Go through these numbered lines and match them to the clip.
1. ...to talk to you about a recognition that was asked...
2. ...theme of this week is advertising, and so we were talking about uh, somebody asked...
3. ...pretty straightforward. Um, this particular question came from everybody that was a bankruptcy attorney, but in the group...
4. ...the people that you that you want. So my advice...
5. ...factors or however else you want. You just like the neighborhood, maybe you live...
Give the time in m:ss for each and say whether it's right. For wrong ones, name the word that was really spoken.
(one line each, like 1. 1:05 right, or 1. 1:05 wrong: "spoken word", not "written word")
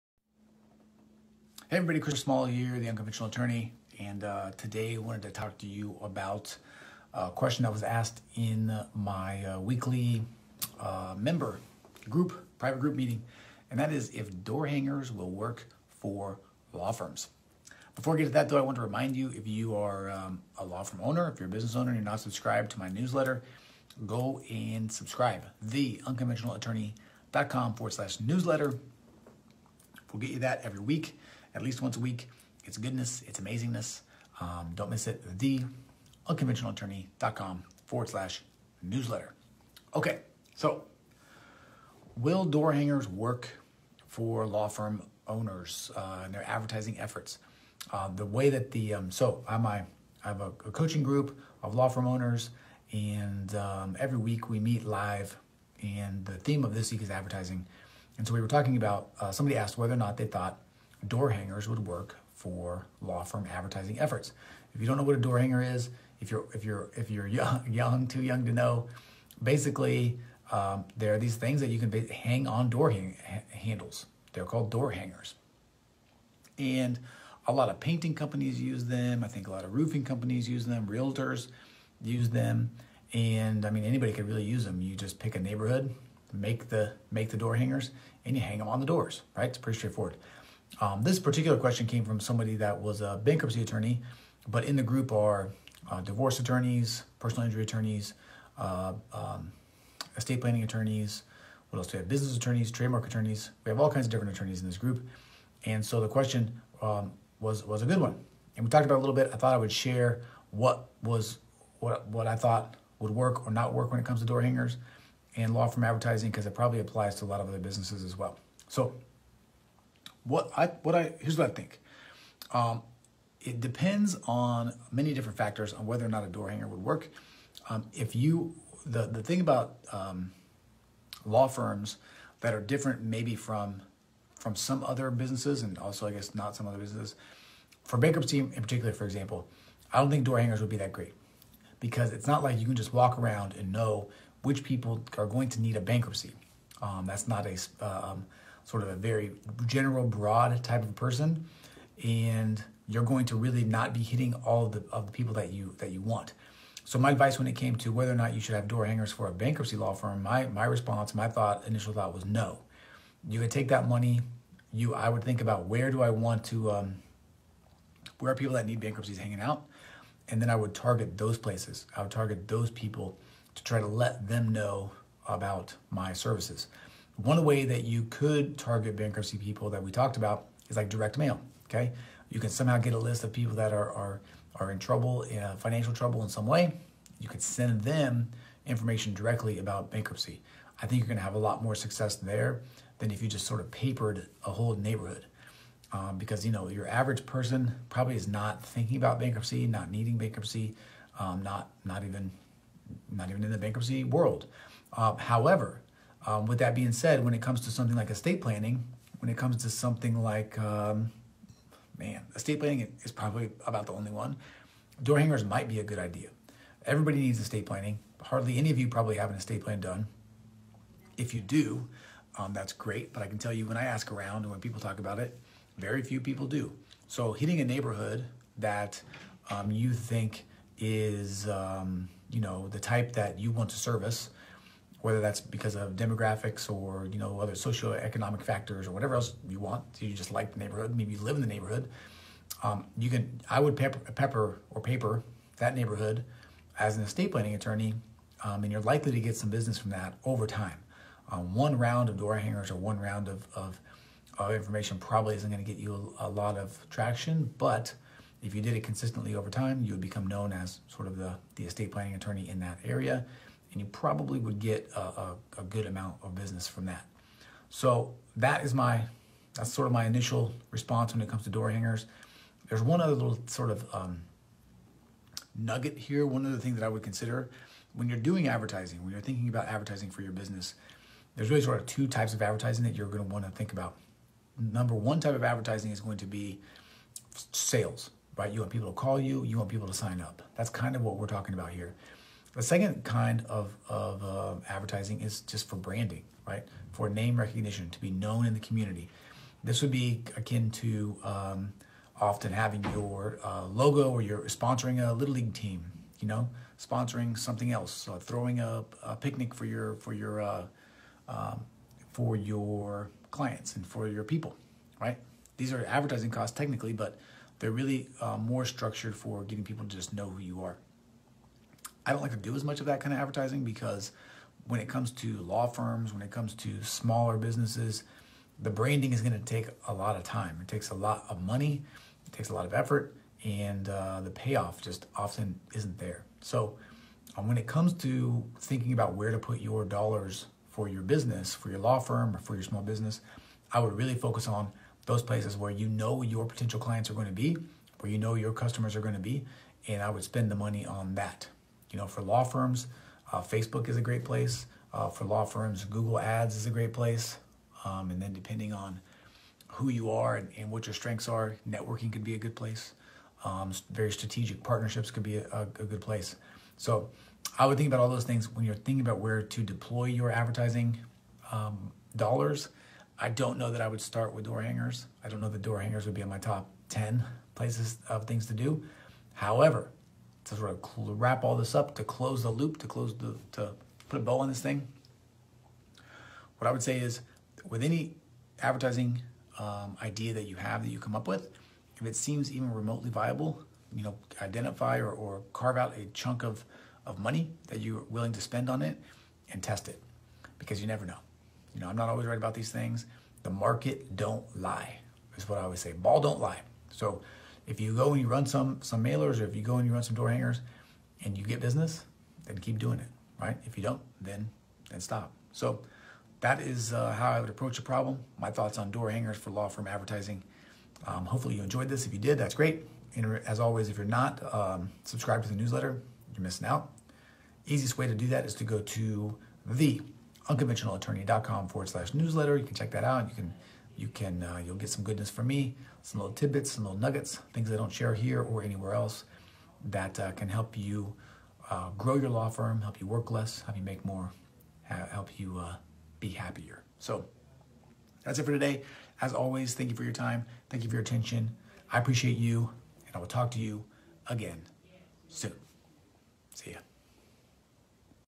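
1. 0:05 wrong: "question", not "recognition"
2. 0:56 right
3. 1:29 wrong: "somebody", not "everybody"
4. 2:35 right
5. 3:58 wrong: "whatever", not "however".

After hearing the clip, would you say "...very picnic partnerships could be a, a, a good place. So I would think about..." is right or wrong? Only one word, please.
wrong.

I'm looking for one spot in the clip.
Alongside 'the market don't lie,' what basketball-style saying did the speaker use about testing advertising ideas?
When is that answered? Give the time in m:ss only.
6:45.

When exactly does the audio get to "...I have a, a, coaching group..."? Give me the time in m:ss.
0:50.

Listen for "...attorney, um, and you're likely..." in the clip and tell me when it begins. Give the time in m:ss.
4:07.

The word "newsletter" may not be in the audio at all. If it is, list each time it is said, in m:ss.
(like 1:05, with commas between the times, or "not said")
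0:22, 0:28, 0:38, 7:05, 7:12.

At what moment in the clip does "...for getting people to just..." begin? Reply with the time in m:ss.
5:19.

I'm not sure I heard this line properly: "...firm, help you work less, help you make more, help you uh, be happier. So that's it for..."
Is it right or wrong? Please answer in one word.
right.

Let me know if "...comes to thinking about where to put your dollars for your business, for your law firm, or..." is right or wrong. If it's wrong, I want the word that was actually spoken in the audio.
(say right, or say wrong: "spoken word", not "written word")
right.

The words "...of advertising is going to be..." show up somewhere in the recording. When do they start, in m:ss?
4:45.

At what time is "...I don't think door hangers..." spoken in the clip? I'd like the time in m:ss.
2:19.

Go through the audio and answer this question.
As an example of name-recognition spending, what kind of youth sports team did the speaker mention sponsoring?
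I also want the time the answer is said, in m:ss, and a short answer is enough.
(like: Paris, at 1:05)
Little League team, at 5:05.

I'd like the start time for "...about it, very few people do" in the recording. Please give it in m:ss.
3:44.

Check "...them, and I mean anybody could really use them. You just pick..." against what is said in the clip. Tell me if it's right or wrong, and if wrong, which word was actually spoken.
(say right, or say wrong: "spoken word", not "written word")
right.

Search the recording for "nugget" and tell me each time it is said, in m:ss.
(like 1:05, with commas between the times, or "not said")
4:35, 7:16.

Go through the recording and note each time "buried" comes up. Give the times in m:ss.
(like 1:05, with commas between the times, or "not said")
not said.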